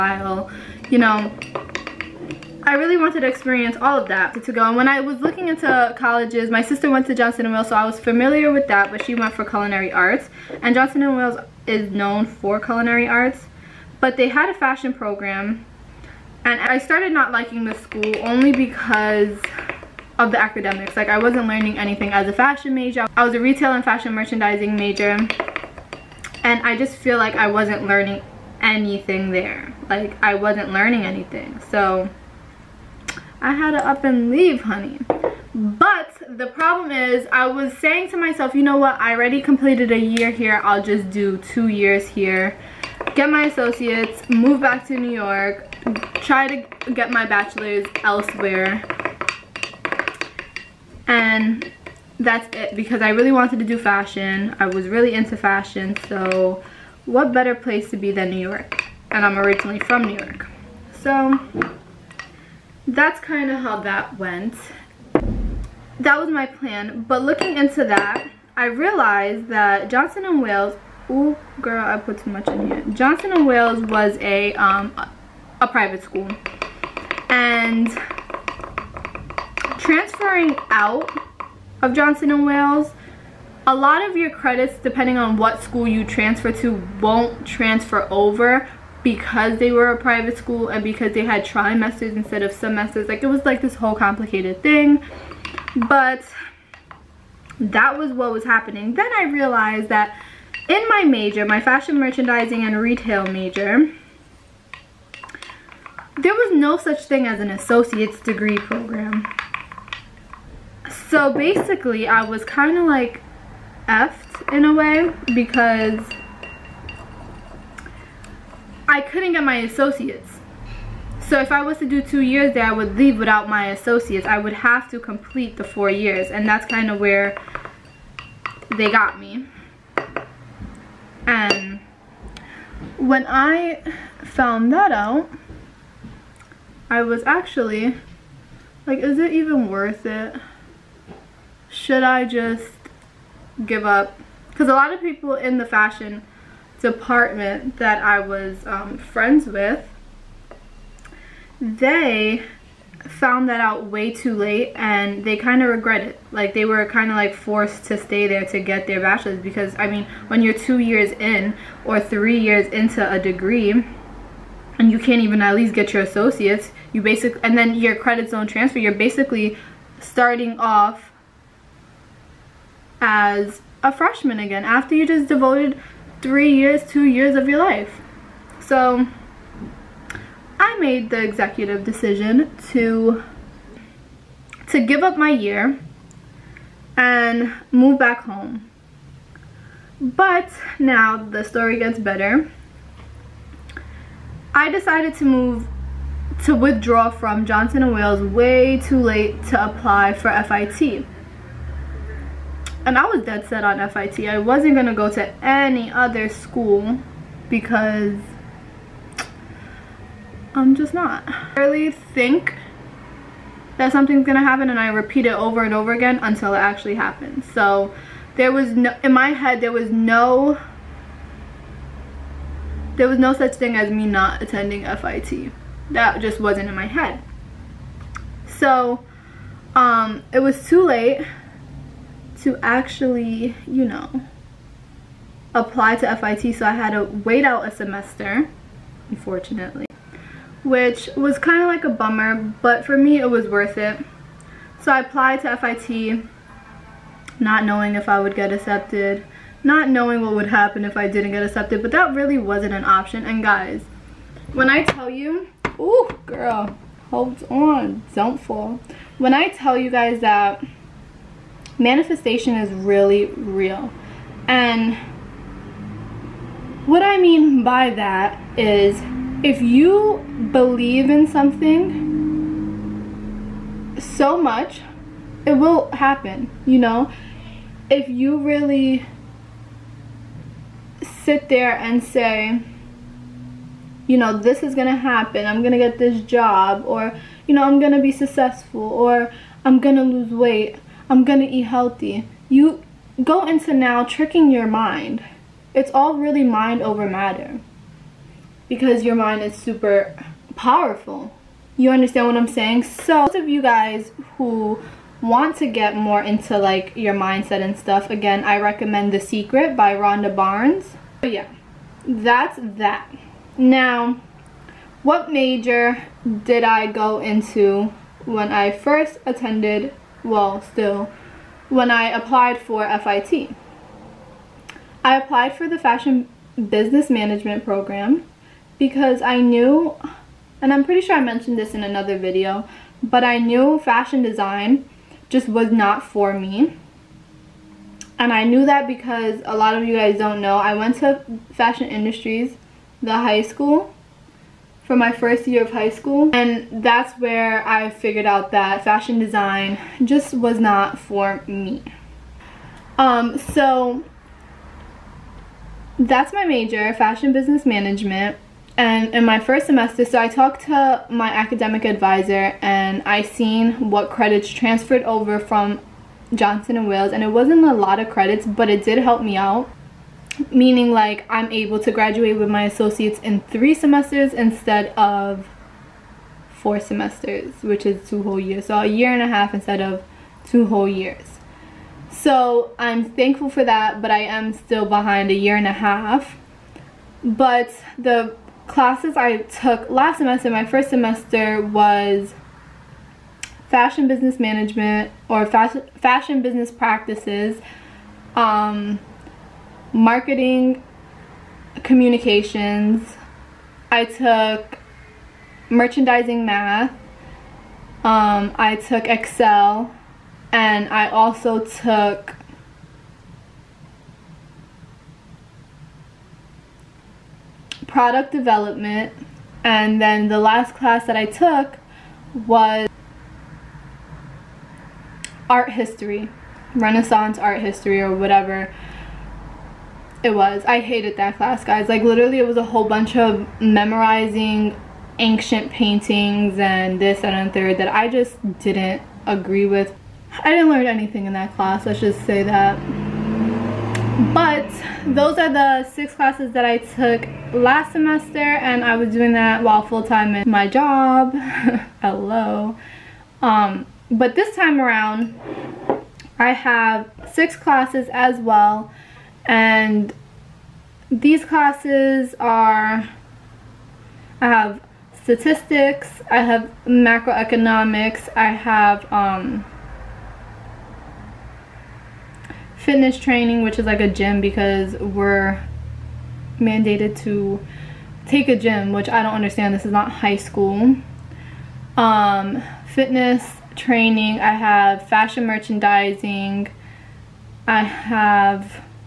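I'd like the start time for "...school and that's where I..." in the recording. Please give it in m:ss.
5:45.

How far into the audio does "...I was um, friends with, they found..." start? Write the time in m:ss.
2:28.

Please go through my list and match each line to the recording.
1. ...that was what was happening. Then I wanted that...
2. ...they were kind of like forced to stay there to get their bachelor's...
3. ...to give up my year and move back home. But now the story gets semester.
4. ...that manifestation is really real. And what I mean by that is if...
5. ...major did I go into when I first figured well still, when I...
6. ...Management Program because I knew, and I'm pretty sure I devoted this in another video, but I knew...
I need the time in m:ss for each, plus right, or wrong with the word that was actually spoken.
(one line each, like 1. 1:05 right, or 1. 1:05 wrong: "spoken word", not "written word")
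1. 1:37 wrong: "realized", not "wanted"
2. 2:36 right
3. 3:04 wrong: "better", not "semester"
4. 4:20 right
5. 5:15 wrong: "attended", not "figured"
6. 5:27 wrong: "mentioned", not "devoted".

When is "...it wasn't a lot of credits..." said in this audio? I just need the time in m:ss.
6:07.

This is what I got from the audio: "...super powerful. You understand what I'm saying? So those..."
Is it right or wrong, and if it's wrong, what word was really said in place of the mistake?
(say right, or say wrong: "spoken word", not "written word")
right.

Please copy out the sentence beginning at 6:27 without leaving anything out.
But the classes I took last semester, my first semester was fashion business management or fashion, fashion business practices, um, marketing, communications.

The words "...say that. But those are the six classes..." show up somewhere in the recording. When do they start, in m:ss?
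7:22.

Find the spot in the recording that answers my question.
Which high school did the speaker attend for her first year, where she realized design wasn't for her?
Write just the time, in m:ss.
5:41.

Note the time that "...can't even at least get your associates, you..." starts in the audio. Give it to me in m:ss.
2:44.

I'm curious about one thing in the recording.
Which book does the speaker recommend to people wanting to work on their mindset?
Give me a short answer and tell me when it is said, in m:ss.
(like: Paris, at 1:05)
The Secret, at 5:09.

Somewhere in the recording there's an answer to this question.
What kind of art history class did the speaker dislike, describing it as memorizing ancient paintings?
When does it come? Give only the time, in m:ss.
7:06.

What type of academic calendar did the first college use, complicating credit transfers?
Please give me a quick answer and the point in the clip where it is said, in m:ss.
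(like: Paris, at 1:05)
trimesters, at 1:31.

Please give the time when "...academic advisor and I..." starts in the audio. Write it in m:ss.
6:01.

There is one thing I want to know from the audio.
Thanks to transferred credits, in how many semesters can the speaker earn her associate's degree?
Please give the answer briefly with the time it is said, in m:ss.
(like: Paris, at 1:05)
3, at 6:13.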